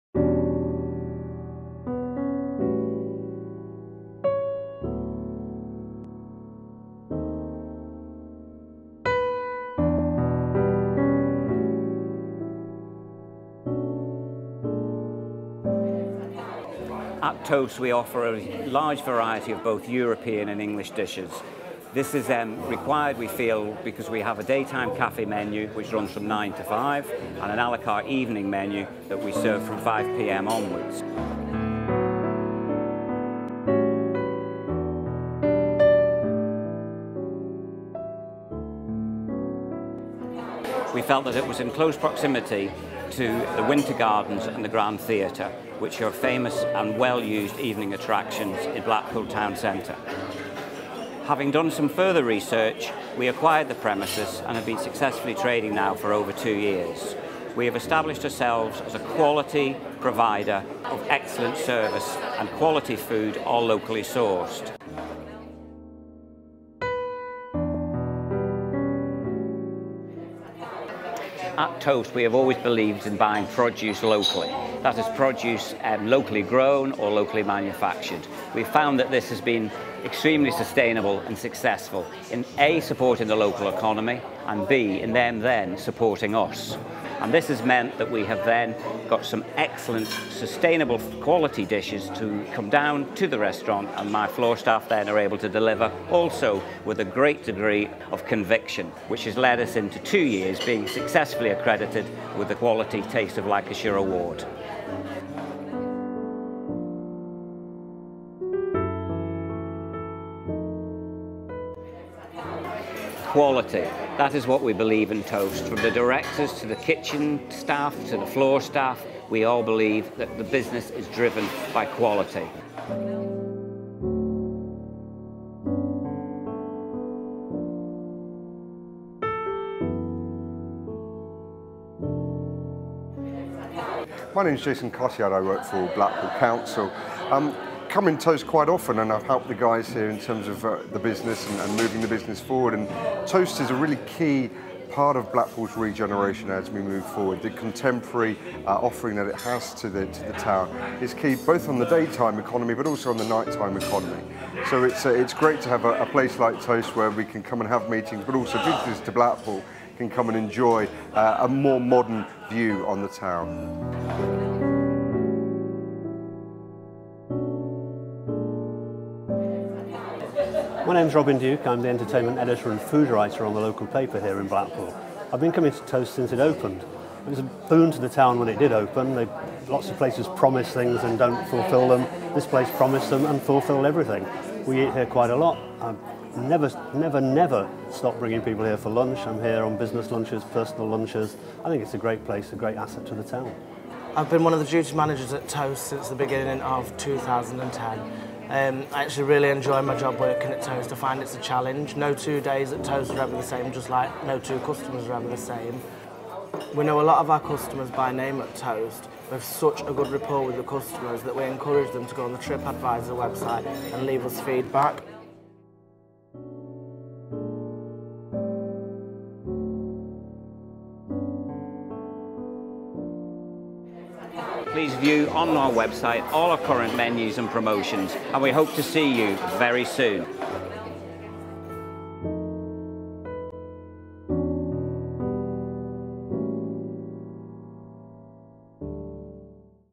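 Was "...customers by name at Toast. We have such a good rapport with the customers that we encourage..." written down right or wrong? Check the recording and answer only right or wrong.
right.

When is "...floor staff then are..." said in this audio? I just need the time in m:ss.
1:34.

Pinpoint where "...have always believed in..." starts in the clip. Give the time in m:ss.
1:12.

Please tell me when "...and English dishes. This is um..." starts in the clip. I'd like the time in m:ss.
0:20.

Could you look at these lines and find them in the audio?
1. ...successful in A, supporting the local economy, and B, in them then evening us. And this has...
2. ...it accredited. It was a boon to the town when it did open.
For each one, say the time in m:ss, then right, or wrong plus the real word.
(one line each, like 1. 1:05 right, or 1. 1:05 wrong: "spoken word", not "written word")
1. 1:21 wrong: "supporting", not "evening"
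2. 2:56 wrong: "opened", not "accredited".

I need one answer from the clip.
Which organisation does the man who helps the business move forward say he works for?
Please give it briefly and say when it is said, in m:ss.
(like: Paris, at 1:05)
Blackpool Council, at 2:15.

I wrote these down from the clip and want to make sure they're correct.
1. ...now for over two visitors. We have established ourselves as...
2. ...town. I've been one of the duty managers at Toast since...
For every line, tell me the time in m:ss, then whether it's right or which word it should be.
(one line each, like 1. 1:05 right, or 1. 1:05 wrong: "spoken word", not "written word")
1. 0:55 wrong: "years", not "visitors"
2. 3:13 right.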